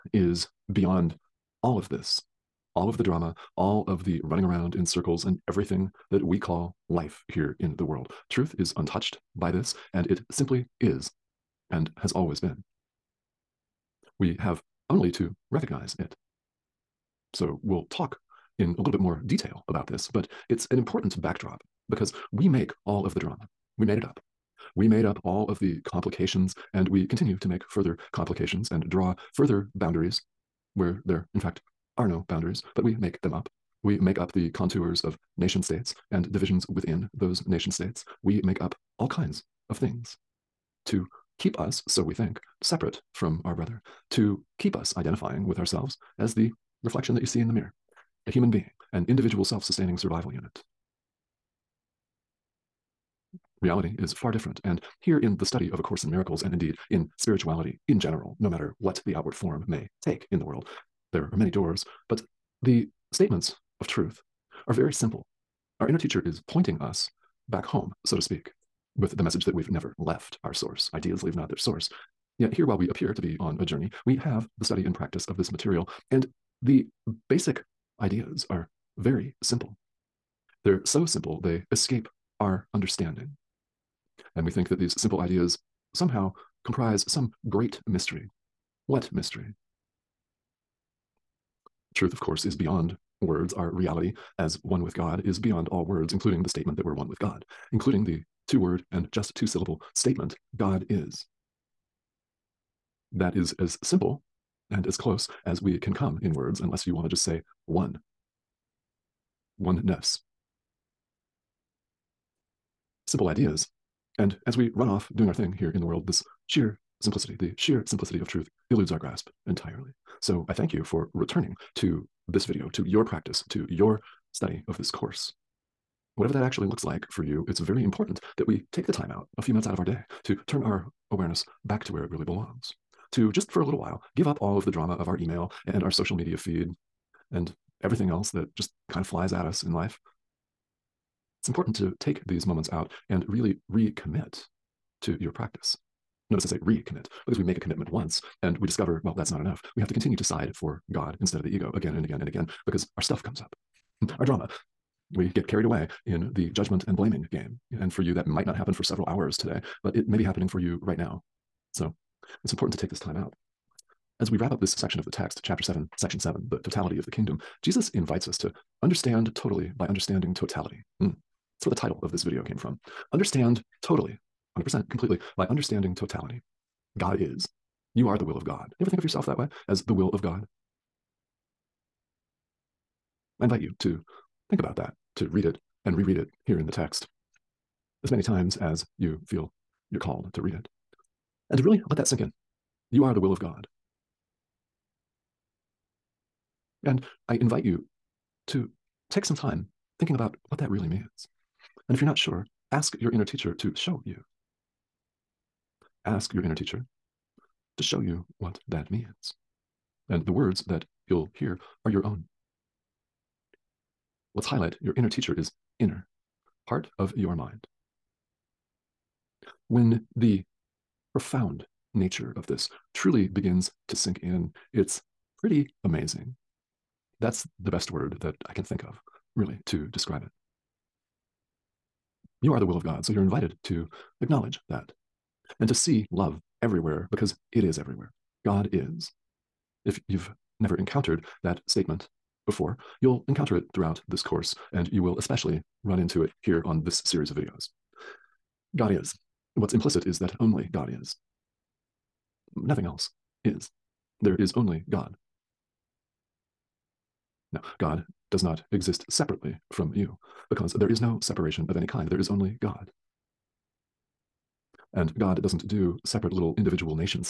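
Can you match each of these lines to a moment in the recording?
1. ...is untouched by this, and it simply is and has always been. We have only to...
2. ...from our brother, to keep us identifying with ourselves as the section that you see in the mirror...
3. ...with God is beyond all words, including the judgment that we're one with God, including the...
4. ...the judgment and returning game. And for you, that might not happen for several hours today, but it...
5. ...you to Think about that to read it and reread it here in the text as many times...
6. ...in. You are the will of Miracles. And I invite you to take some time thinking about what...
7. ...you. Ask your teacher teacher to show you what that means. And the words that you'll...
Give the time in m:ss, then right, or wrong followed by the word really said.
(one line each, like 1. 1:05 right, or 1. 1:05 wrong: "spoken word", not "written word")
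1. 0:08 right
2. 0:43 wrong: "reflection", not "section"
3. 1:34 wrong: "statement", not "judgment"
4. 2:36 wrong: "blaming", not "returning"
5. 3:03 right
6. 3:12 wrong: "God", not "Miracles"
7. 3:24 wrong: "inner", not "teacher".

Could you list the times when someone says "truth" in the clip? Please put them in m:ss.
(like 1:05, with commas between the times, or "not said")
0:08, 1:03, 1:31, 1:58.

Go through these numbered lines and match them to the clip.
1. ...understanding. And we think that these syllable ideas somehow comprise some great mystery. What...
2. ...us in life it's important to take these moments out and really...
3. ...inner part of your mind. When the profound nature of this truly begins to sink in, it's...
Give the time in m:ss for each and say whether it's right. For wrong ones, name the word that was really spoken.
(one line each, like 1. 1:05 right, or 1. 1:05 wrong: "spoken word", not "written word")
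1. 1:22 wrong: "simple", not "syllable"
2. 2:19 right
3. 3:35 right.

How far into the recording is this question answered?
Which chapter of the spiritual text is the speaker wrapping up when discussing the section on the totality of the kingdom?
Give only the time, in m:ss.
2:45.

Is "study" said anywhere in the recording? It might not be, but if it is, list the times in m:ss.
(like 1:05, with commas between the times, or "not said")
0:55, 1:14, 2:04.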